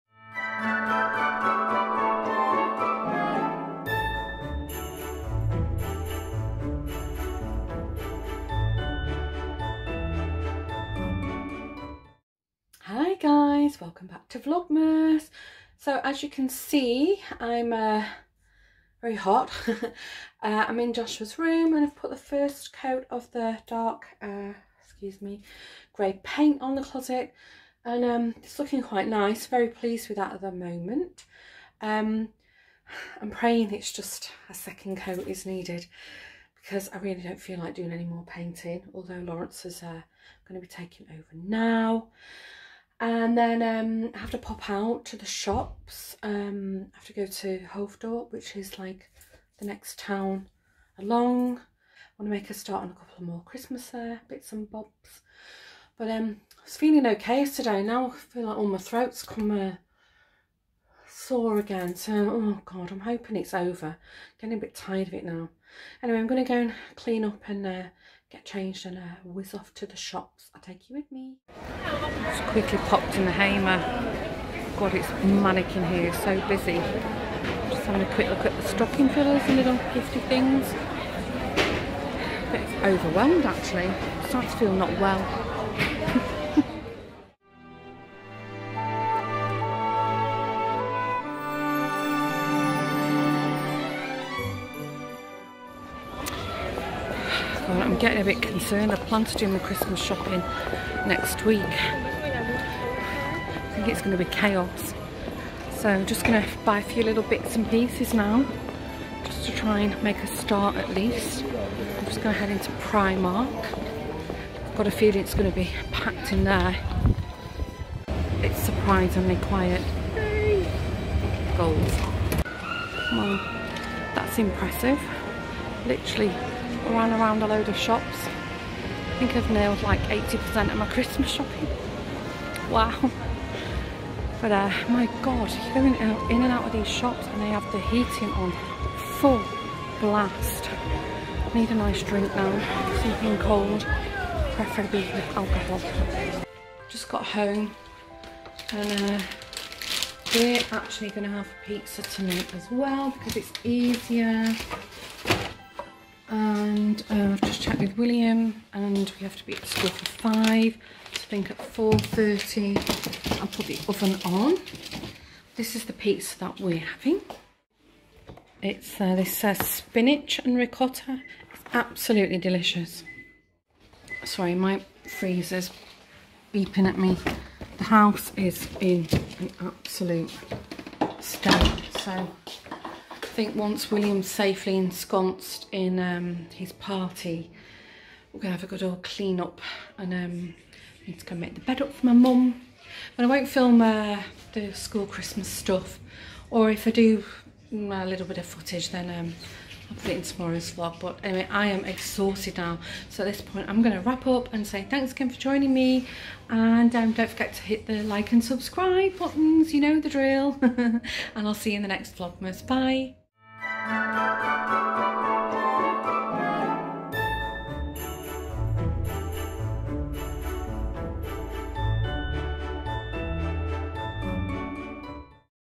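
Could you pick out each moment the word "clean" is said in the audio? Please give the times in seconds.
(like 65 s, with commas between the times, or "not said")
66 s, 189 s.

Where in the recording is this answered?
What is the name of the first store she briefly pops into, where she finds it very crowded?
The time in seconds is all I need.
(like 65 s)
73 s.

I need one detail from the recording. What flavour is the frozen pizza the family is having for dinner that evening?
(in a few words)
Spinach and ricotta.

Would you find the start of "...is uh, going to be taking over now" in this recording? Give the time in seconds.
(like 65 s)
39 s.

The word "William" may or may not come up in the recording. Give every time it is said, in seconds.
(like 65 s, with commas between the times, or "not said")
157 s, 183 s.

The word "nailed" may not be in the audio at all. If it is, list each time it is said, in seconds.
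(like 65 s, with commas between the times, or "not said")
129 s.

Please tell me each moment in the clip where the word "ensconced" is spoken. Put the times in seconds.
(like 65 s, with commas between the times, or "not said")
184 s.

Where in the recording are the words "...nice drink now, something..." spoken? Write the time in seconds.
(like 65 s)
141 s.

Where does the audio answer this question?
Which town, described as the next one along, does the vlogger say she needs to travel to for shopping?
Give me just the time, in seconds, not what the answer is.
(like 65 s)
47 s.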